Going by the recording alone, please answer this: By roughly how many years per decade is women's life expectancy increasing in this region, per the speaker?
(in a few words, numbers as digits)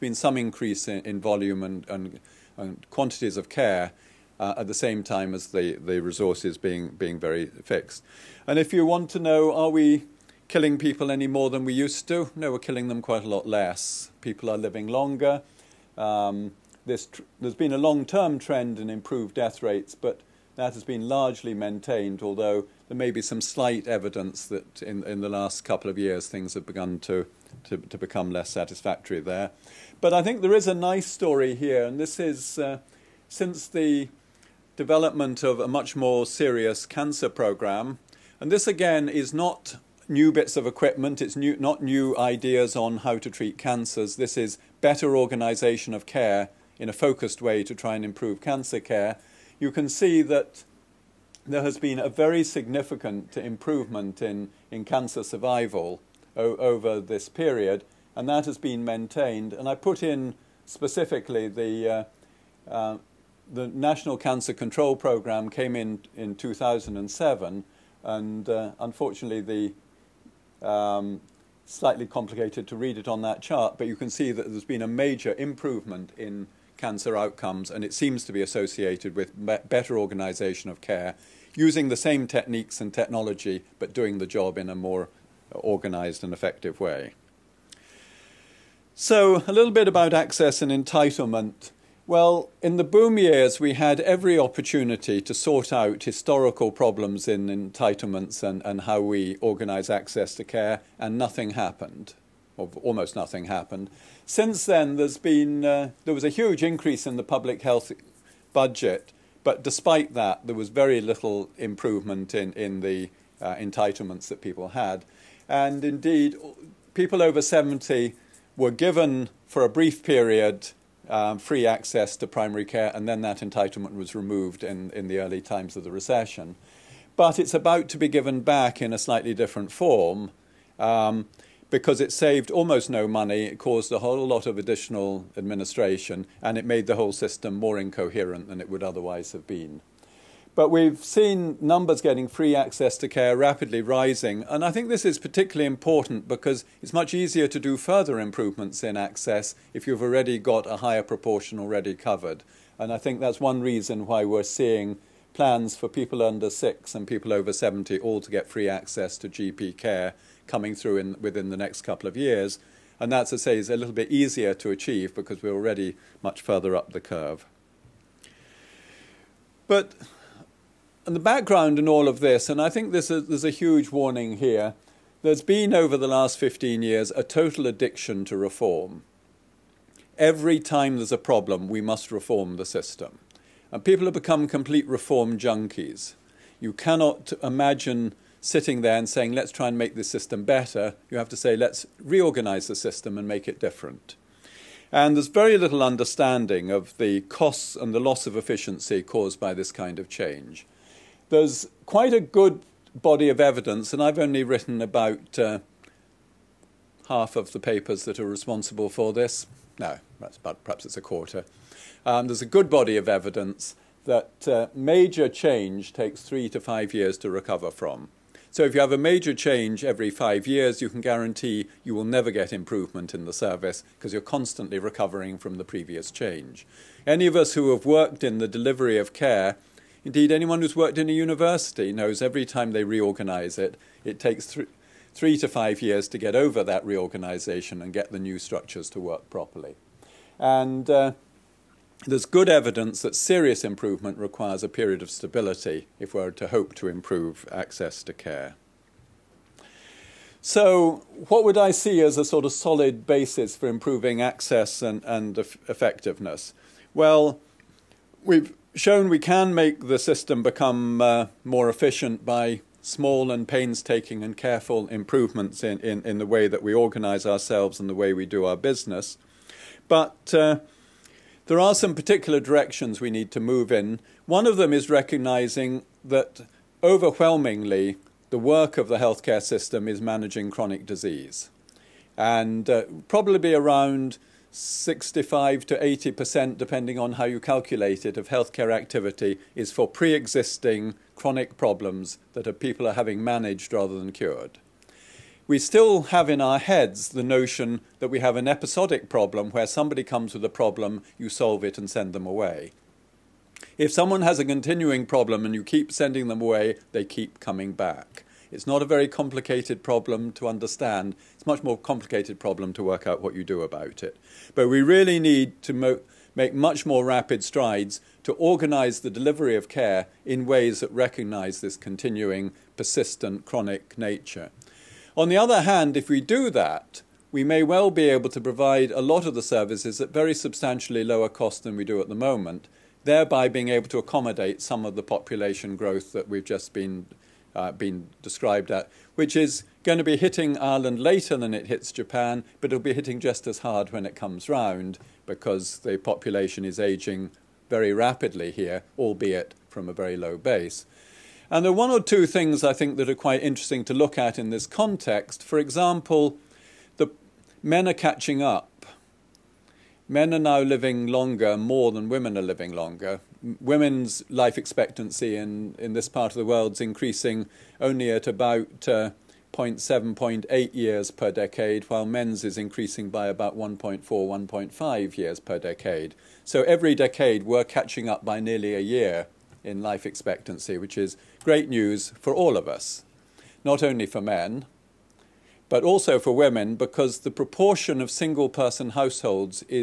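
0.7 to 0.8 years.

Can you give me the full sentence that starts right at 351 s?
And there are one or two things I think that are quite interesting to look at in this context.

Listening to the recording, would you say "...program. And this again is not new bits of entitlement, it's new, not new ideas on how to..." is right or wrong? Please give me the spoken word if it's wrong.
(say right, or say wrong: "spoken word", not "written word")
wrong: "equipment", not "entitlement".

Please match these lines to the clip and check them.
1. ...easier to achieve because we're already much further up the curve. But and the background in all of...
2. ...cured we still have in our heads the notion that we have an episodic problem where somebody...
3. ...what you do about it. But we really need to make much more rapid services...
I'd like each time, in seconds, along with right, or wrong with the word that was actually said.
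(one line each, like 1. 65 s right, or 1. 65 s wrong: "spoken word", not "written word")
1. 164 s right
2. 294 s right
3. 313 s wrong: "strides", not "services".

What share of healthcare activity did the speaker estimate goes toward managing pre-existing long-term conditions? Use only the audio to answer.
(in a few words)
65 to 80%.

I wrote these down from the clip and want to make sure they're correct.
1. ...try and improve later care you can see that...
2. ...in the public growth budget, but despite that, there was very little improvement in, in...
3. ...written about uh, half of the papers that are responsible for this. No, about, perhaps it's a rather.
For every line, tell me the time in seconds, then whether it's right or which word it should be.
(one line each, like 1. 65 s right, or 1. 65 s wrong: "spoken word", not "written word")
1. 47 s wrong: "cancer", not "later"
2. 107 s wrong: "health", not "growth"
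3. 204 s wrong: "quarter", not "rather".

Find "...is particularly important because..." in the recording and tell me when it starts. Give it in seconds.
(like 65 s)
145 s.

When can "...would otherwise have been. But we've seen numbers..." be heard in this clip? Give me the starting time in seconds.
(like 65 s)
138 s.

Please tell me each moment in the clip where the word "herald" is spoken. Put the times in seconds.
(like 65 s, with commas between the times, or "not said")
not said.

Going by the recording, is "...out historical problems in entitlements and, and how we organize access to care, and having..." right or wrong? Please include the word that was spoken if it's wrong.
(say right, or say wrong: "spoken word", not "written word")
wrong: "nothing", not "having".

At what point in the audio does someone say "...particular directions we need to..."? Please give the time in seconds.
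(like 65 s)
271 s.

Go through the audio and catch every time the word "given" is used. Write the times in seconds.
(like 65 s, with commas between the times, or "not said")
118 s, 128 s.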